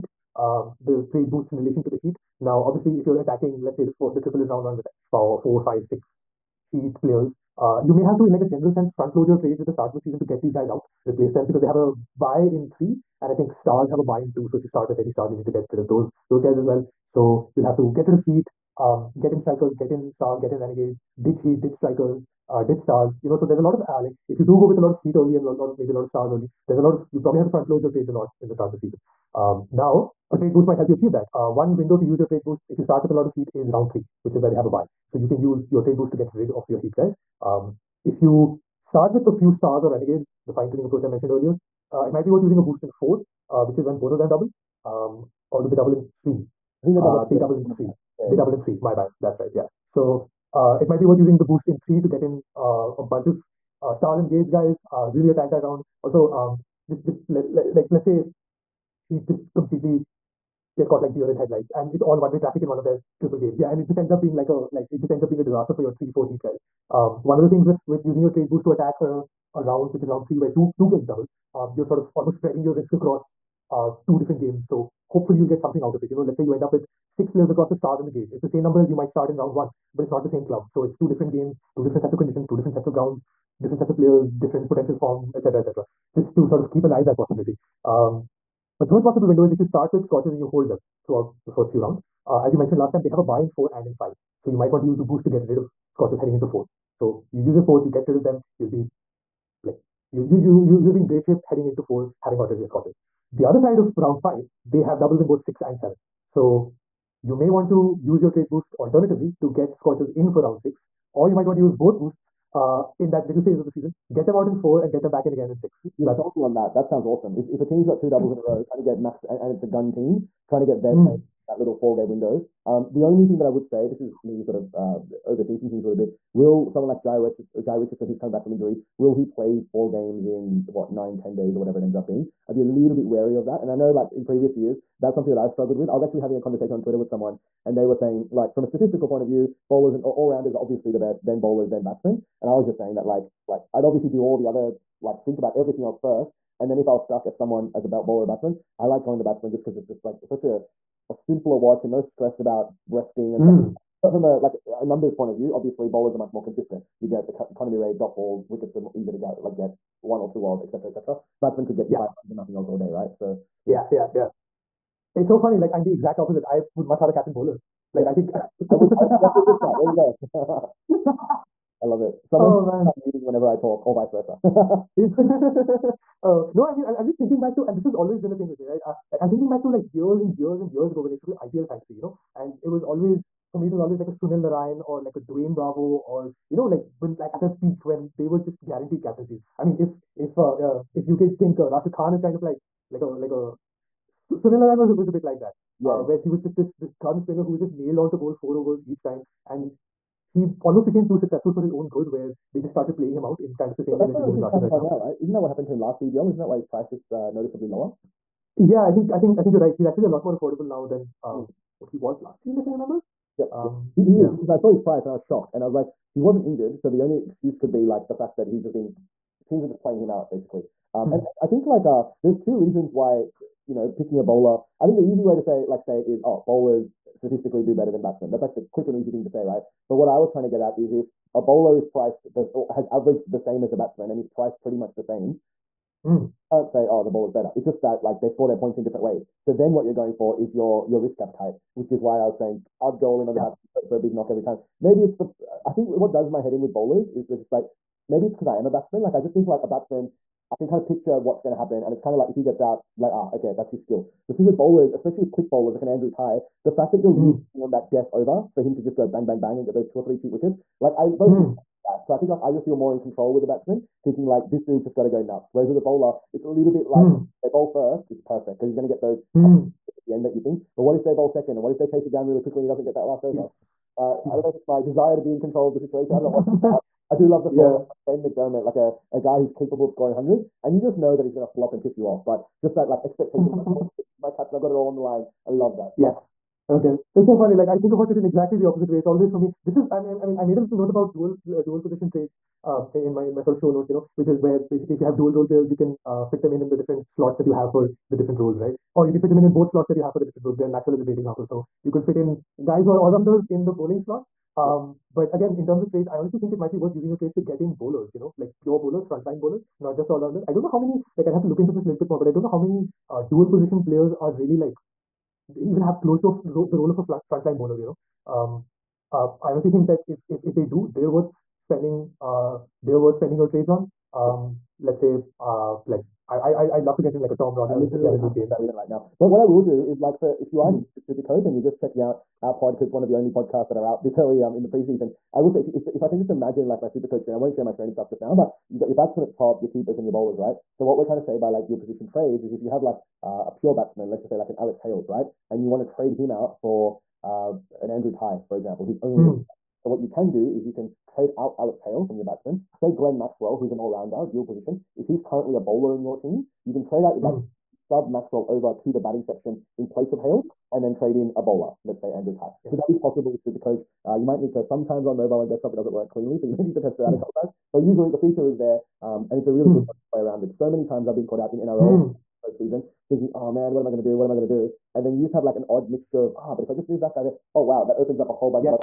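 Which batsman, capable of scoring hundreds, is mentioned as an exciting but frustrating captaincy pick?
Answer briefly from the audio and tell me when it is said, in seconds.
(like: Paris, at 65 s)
Ben McDermott, at 278 s.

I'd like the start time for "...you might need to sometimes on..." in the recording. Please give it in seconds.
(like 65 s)
364 s.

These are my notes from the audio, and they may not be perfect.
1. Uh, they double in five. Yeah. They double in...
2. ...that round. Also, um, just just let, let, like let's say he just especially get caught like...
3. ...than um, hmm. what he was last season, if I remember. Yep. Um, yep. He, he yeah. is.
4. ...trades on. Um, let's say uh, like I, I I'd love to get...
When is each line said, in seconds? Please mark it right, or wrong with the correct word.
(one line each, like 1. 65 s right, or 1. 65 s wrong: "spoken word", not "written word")
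1. 47 s wrong: "three", not "five"
2. 55 s wrong: "completely", not "especially"
3. 210 s right
4. 323 s right.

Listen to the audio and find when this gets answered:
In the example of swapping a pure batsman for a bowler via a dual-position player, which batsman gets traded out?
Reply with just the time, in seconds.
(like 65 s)
344 s.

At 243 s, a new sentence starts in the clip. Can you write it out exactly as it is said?
bat for a big knock every time.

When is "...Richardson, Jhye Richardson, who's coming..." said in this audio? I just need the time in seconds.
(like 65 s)
127 s.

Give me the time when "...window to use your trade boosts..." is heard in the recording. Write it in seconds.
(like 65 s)
31 s.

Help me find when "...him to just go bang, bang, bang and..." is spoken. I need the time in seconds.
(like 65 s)
258 s.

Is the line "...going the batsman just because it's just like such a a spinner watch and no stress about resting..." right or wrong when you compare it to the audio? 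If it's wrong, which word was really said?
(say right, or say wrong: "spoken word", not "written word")
wrong: "simpler", not "spinner".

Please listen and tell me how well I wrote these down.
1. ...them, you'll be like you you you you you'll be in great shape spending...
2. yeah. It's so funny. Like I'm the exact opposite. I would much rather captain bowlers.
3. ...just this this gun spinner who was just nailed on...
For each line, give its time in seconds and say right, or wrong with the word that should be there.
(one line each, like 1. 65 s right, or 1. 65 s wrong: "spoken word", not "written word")
1. 98 s wrong: "heading", not "spending"
2. 164 s right
3. 196 s right.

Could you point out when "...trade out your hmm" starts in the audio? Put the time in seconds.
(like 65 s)
356 s.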